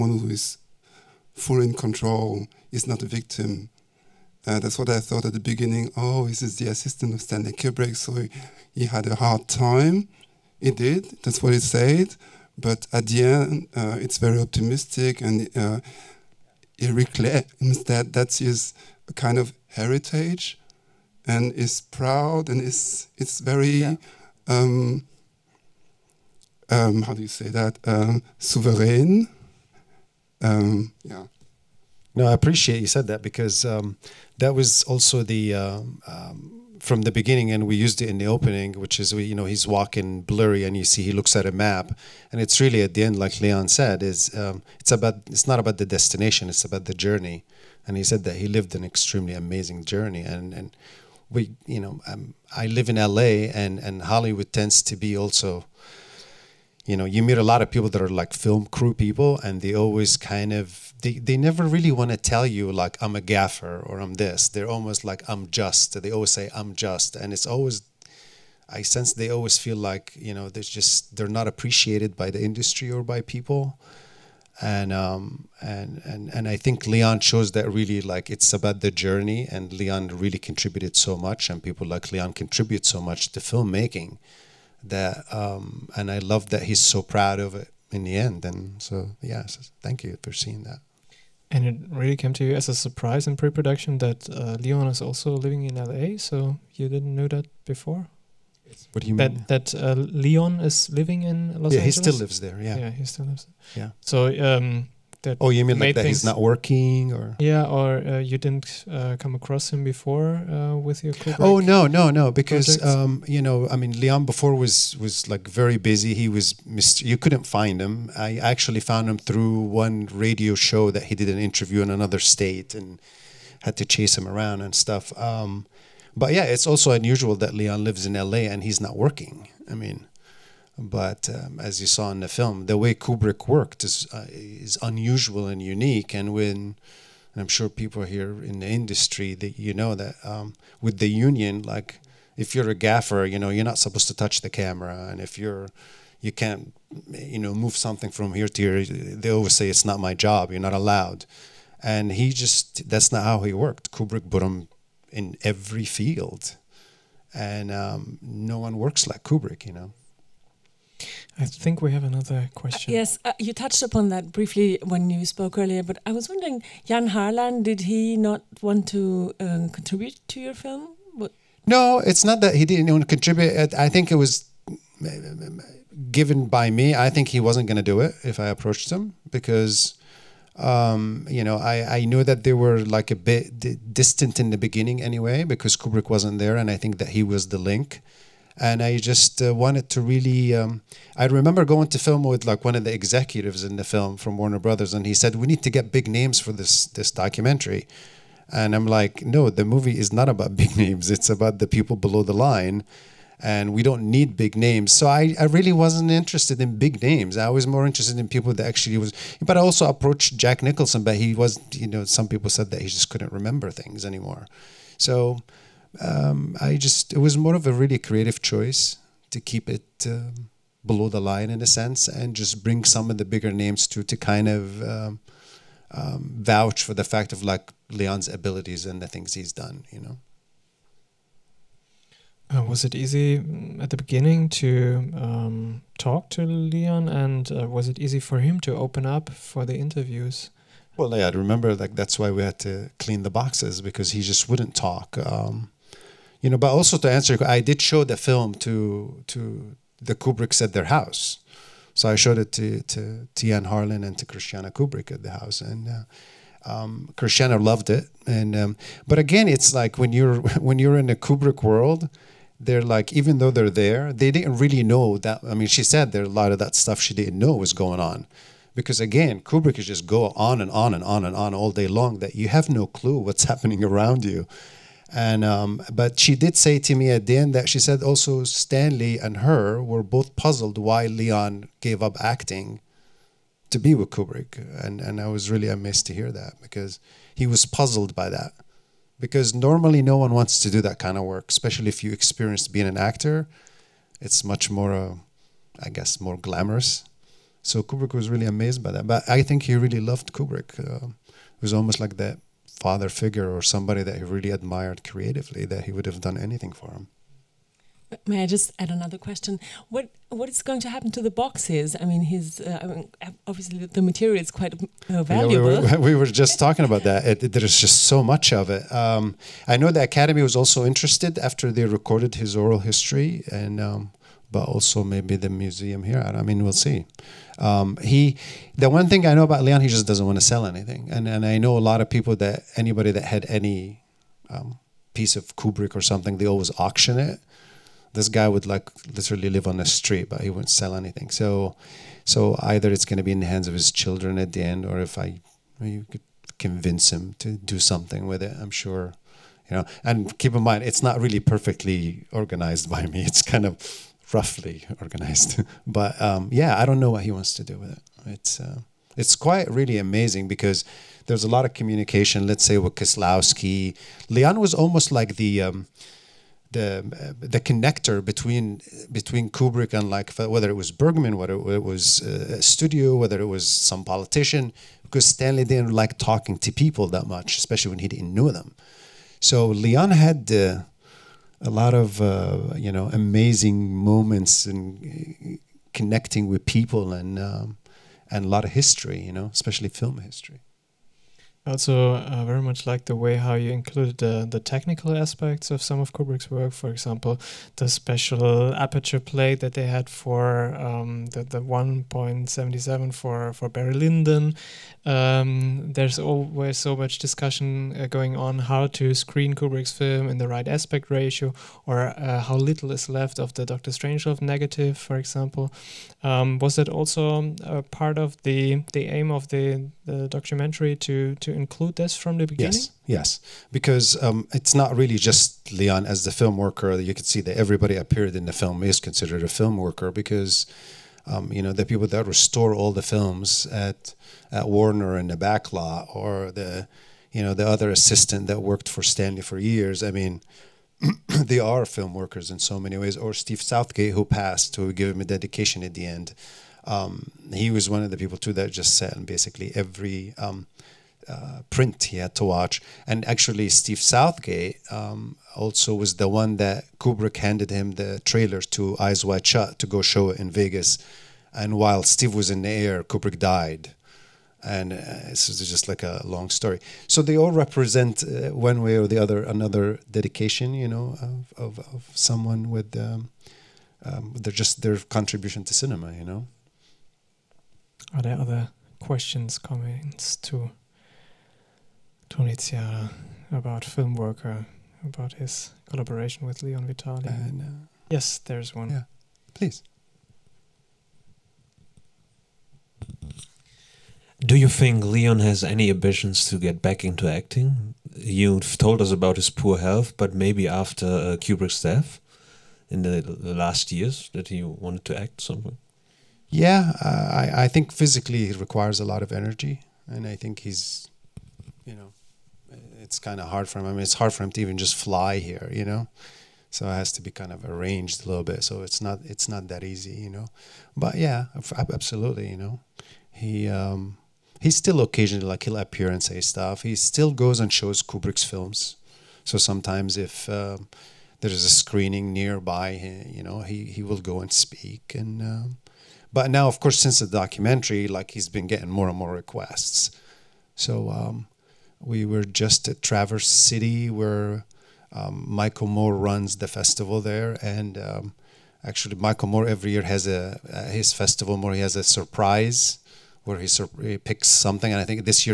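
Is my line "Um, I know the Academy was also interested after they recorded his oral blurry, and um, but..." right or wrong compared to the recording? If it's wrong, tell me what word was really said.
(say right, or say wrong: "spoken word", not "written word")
wrong: "history", not "blurry".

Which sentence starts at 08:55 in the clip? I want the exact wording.
Um, but now, of course, since the documentary, like he's been getting more and more requests.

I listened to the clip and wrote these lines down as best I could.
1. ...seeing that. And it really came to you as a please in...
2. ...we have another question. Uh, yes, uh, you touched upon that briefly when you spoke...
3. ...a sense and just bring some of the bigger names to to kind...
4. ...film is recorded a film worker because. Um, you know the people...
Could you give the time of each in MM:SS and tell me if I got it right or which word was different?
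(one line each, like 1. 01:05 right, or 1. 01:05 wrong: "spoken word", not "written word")
1. 01:30 wrong: "surprise", not "please"
2. 02:41 right
3. 03:41 right
4. 07:08 wrong: "considered", not "recorded".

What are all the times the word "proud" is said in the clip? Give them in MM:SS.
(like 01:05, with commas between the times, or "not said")
00:21, 01:27.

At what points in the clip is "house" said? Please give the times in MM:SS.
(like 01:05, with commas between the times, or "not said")
04:10, 04:15.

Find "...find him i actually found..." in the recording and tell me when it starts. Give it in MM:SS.
01:57.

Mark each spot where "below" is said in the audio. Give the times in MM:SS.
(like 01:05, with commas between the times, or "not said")
03:21, 03:40.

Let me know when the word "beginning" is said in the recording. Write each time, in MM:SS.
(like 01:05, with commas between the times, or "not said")
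00:05, 00:37, 03:04, 03:53, 07:02.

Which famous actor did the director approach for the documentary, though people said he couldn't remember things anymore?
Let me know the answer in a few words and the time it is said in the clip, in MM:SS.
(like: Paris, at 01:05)
Jack Nicholson, at 03:30.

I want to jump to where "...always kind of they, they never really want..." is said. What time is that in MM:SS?
00:59.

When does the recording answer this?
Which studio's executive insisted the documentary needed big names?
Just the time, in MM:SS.
03:14.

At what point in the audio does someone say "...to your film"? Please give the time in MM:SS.
02:50.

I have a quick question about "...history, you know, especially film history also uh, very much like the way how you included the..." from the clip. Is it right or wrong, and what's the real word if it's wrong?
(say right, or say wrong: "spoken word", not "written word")
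right.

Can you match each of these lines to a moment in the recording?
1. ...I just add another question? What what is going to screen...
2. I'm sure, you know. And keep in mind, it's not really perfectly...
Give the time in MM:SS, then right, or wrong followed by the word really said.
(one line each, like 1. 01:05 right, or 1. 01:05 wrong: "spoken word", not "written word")
1. 05:08 wrong: "happen", not "screen"
2. 05:48 right.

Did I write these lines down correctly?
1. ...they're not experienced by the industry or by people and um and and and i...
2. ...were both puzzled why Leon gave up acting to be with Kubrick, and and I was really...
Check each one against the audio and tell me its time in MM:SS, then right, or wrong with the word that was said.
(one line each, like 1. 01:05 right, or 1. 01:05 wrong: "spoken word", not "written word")
1. 01:11 wrong: "appreciated", not "experienced"
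2. 04:39 right.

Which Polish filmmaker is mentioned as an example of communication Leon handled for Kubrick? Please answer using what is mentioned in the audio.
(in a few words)
Kieslowski.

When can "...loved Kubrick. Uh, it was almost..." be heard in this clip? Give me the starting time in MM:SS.
05:00.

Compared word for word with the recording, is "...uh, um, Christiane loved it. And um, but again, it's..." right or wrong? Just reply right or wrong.
right.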